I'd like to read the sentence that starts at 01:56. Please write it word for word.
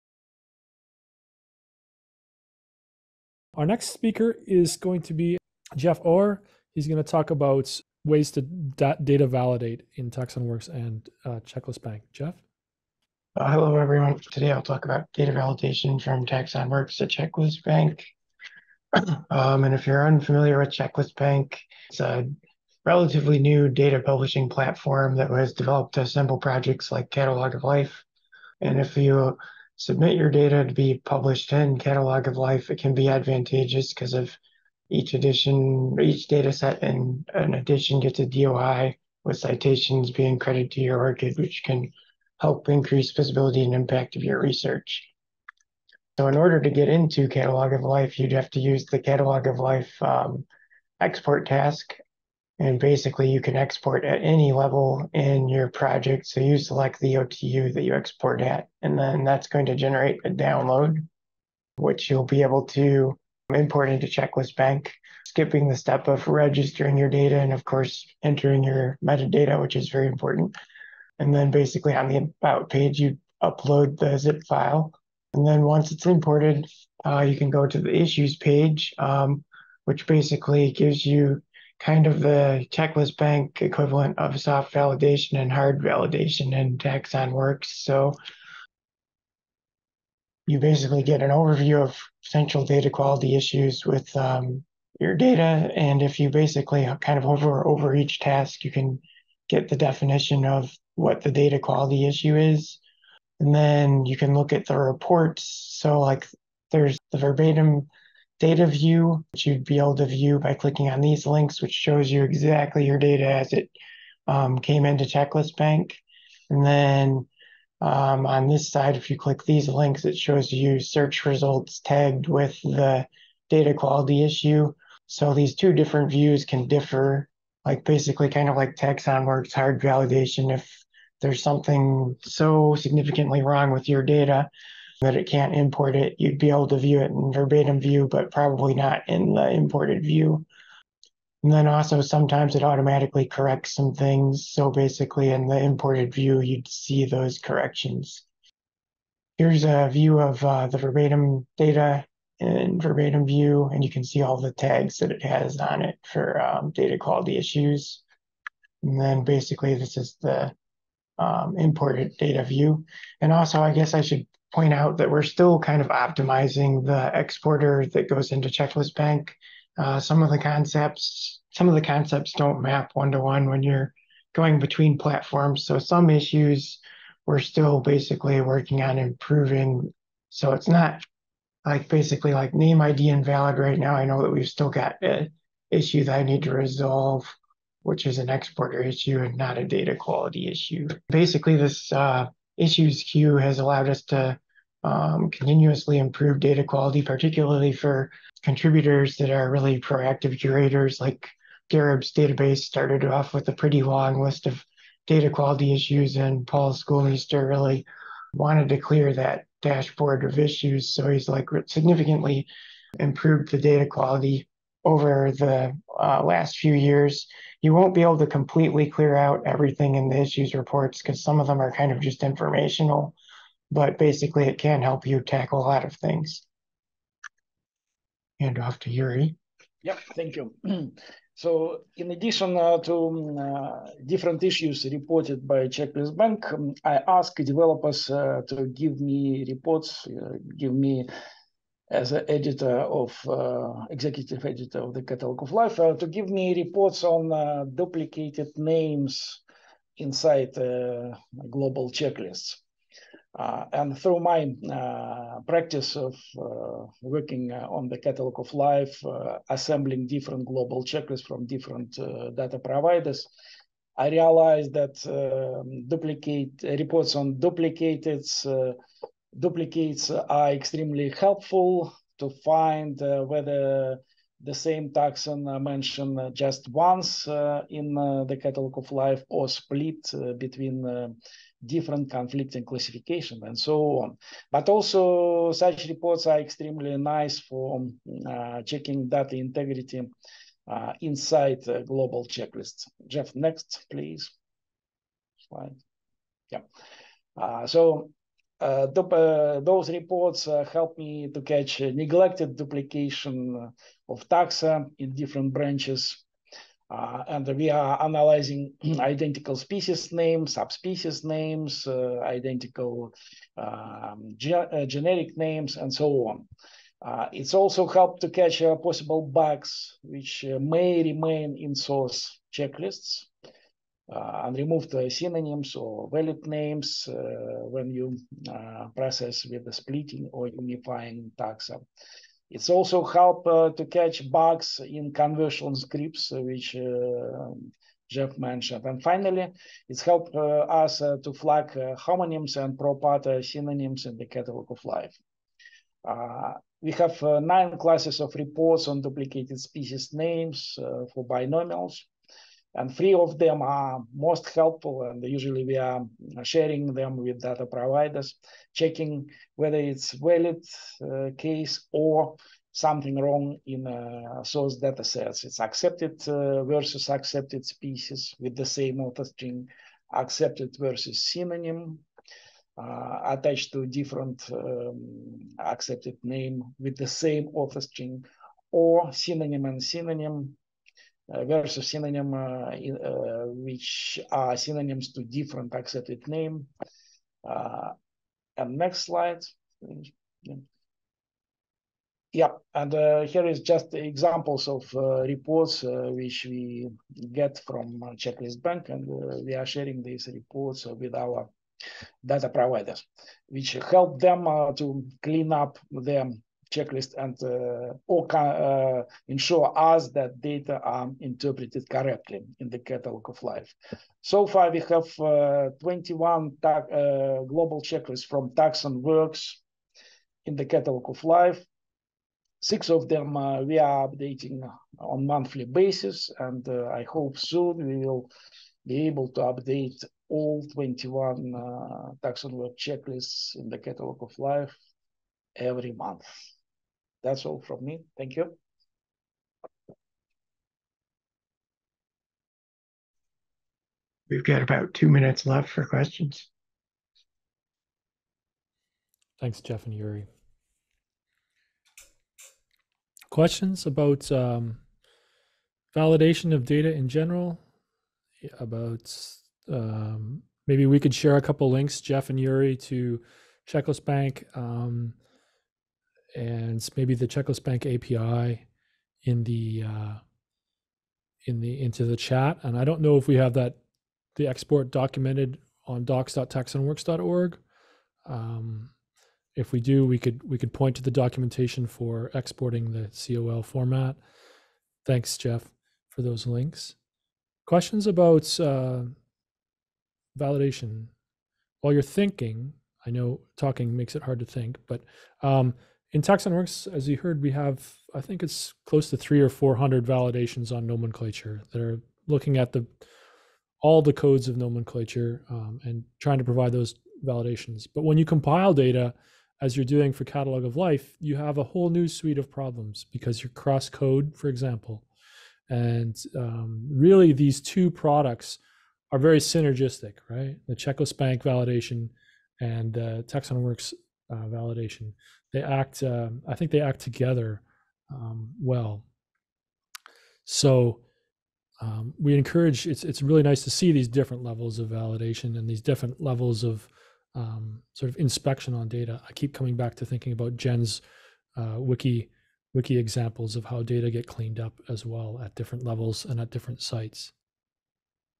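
And then um, on this side, if you click these links, it shows you search results tagged with the data quality issue.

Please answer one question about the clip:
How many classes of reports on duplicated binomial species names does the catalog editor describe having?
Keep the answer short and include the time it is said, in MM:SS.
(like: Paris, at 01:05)
9, at 05:47.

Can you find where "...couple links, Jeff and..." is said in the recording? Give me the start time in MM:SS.
07:41.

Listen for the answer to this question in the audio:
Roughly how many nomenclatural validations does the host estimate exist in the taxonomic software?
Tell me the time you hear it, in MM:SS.
08:19.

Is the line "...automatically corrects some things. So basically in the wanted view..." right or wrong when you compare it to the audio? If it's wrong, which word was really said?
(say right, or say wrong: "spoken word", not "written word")
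wrong: "imported", not "wanted".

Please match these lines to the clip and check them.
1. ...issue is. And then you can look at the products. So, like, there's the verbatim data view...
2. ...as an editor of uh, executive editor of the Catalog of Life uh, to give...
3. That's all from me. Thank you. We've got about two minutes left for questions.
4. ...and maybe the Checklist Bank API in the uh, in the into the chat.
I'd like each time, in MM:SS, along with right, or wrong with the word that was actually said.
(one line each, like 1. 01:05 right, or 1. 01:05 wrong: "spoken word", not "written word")
1. 01:42 wrong: "reports", not "products"
2. 04:01 right
3. 07:17 right
4. 07:46 right.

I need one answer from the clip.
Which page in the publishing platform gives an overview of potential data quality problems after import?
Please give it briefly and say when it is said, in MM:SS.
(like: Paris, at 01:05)
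Issues page, at 01:17.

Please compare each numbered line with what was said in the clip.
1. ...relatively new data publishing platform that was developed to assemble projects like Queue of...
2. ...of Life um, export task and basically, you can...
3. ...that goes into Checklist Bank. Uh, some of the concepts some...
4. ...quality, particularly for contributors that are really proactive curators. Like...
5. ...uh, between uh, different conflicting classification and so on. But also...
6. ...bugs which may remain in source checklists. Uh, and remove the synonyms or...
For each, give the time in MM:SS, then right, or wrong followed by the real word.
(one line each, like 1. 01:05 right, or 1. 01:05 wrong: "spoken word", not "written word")
1. 00:22 wrong: "Catalog", not "Queue"
2. 00:49 right
3. 02:47 right
4. 03:16 right
5. 04:40 right
6. 05:19 right.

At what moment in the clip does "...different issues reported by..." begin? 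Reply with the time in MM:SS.
03:54.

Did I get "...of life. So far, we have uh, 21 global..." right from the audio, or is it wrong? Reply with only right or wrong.
right.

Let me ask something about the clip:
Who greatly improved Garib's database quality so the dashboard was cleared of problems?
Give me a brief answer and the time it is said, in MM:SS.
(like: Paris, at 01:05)
Paul Schoolmeester, at 03:26.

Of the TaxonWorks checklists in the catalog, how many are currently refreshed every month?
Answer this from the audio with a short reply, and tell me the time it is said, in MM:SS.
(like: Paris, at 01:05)
6, at 07:02.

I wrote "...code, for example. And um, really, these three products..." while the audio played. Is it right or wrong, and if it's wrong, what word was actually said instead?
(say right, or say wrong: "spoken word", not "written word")
wrong: "two", not "three".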